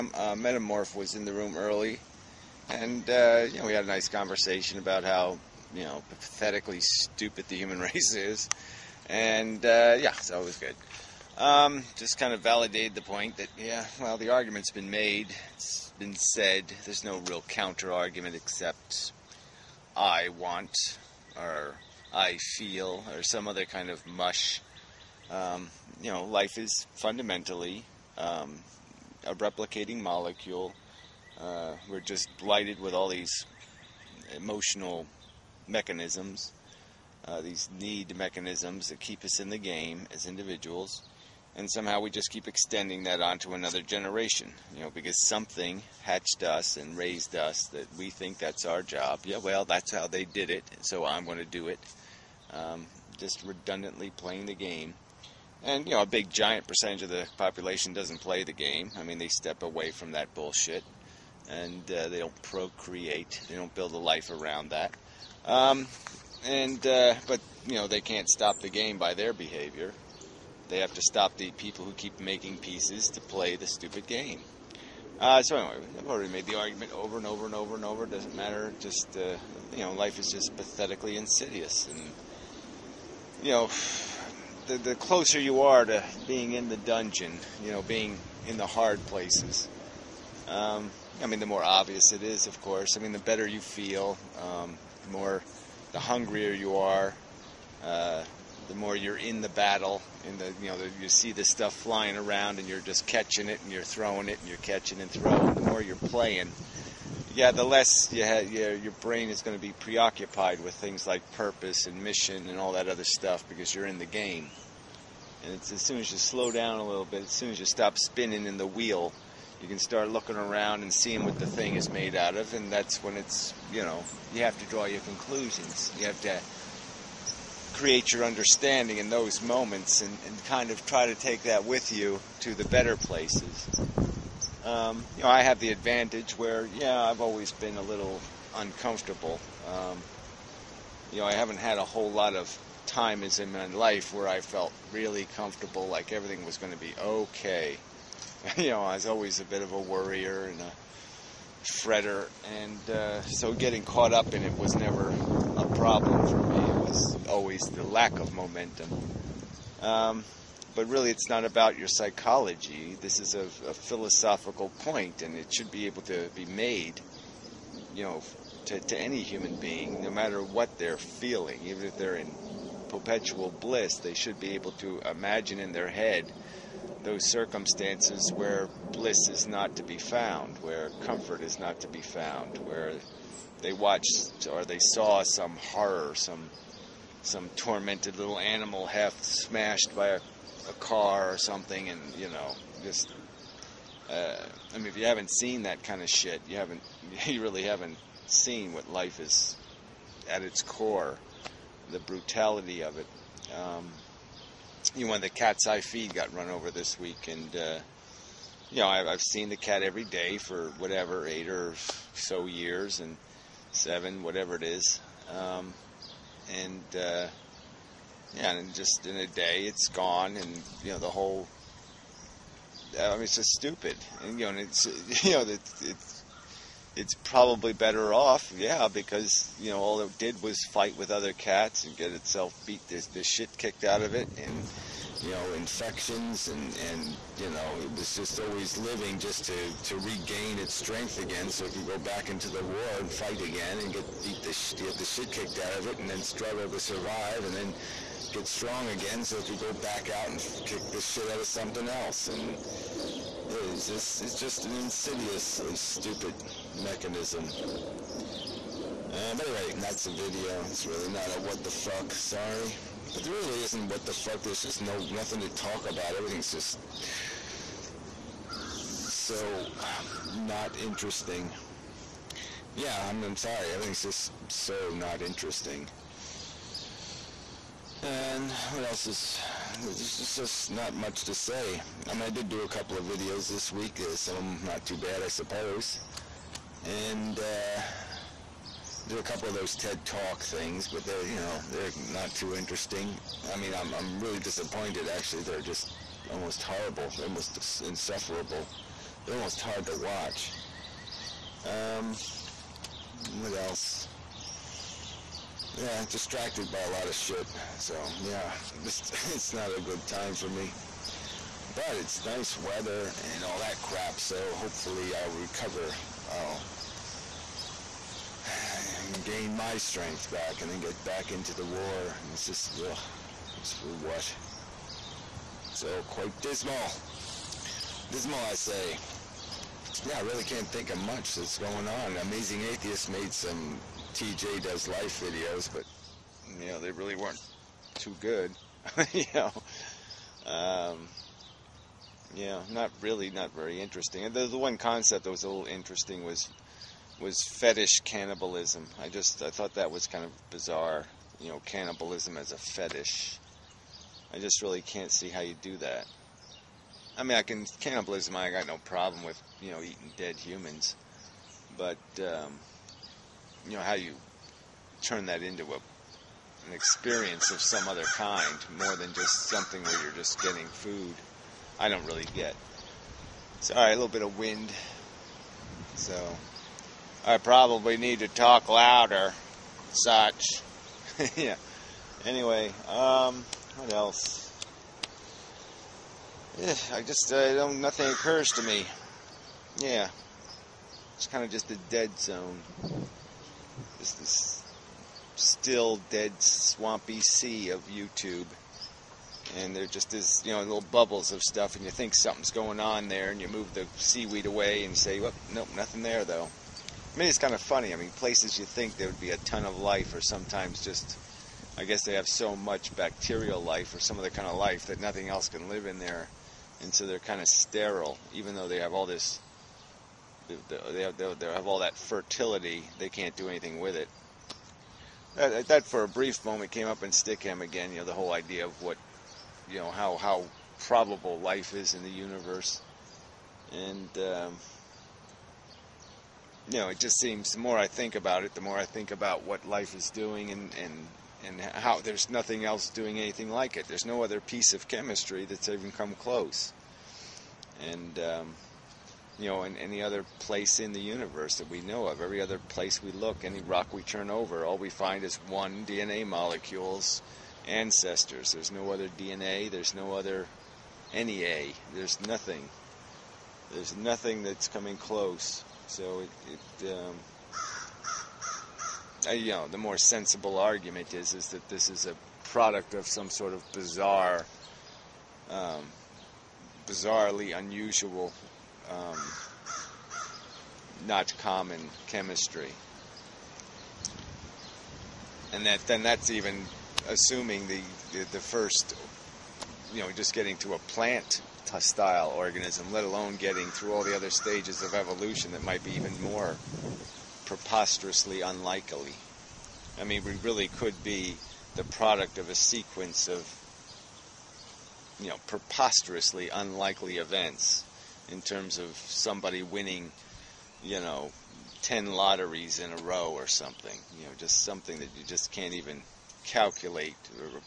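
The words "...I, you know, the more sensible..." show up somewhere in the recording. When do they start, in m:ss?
7:49.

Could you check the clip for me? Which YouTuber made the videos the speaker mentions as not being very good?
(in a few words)
Amazing Atheist.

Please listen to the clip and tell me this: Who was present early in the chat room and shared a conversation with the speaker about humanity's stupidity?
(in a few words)
Metamorph.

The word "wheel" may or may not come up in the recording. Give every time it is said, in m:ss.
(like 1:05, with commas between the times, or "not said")
1:58.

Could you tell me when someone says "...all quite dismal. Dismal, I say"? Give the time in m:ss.
5:25.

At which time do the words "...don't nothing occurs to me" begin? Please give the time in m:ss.
6:27.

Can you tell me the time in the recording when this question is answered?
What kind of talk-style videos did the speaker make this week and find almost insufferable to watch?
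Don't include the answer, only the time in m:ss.
4:49.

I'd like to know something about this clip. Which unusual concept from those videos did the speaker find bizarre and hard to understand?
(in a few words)
fetish cannibalism.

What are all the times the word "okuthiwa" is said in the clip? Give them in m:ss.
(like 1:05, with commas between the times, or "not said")
not said.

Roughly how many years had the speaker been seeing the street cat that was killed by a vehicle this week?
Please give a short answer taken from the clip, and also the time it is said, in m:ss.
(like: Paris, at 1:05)
8, at 3:31.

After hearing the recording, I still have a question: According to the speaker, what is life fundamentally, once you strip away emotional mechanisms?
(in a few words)
a replicating molecule.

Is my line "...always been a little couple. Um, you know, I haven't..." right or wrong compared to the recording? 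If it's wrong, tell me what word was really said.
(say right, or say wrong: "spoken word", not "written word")
wrong: "uncomfortable", not "couple".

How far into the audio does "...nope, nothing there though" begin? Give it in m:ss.
6:45.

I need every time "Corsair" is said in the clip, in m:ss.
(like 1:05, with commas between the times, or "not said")
not said.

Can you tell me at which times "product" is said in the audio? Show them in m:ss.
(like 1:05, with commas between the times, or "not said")
7:52, 8:21.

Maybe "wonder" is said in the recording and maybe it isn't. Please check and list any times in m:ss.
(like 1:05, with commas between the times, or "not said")
not said.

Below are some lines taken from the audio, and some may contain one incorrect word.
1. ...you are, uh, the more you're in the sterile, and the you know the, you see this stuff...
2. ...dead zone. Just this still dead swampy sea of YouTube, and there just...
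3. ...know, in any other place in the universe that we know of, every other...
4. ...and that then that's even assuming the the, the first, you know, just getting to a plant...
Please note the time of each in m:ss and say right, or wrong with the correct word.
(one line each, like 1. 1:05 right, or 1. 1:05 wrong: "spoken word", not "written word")
1. 1:36 wrong: "battle", not "sterile"
2. 6:31 right
3. 7:29 right
4. 8:05 right.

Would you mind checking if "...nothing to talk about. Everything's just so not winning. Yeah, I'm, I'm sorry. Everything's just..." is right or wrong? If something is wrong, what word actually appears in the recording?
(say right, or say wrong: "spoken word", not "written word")
wrong: "interesting", not "winning".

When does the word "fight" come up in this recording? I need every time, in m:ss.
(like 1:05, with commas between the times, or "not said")
3:50, 4:03.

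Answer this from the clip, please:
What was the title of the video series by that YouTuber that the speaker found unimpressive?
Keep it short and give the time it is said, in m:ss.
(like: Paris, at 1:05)
TJ Does Life, at 5:34.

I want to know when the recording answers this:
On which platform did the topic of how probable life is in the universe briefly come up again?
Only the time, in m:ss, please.
7:07.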